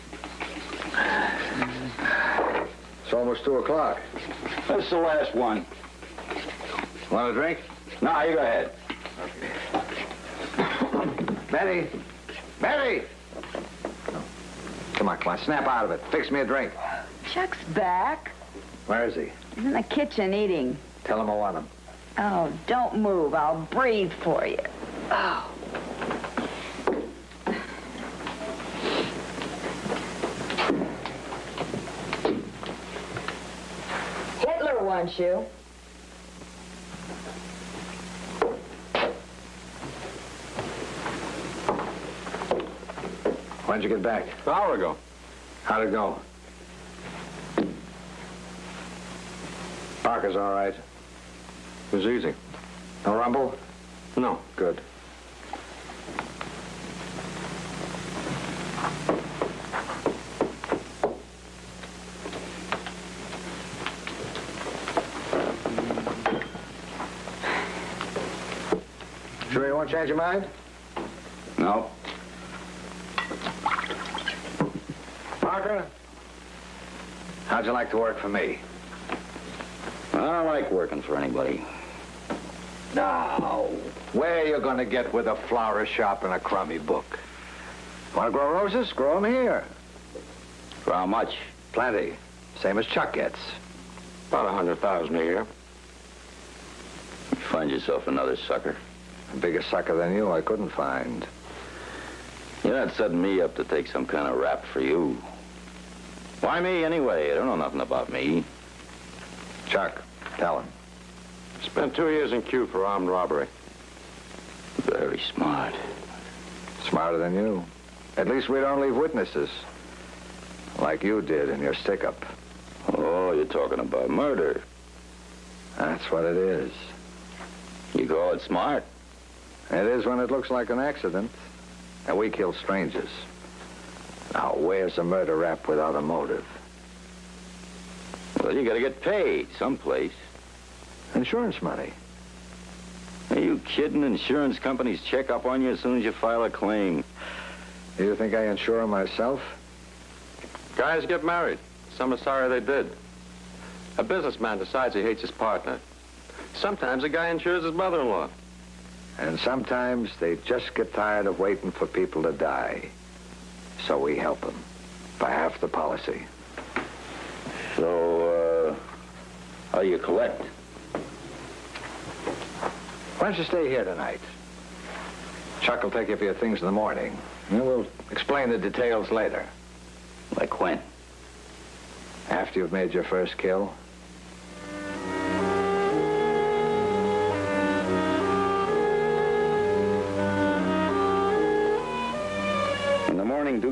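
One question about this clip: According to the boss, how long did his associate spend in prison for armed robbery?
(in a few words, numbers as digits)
2 years.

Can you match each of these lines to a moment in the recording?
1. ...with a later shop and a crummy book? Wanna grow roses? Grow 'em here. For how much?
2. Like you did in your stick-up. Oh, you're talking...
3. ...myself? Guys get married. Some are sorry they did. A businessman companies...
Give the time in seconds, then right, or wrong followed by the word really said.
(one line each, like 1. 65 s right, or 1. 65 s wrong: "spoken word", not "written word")
1. 85 s wrong: "flower", not "later"
2. 120 s right
3. 148 s wrong: "decides", not "companies".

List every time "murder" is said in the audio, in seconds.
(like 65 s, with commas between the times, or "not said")
124 s, 135 s.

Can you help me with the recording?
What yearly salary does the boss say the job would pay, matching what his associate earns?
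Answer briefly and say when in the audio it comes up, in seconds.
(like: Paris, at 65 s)
$100,000, at 94 s.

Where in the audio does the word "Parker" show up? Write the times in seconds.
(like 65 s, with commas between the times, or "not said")
50 s.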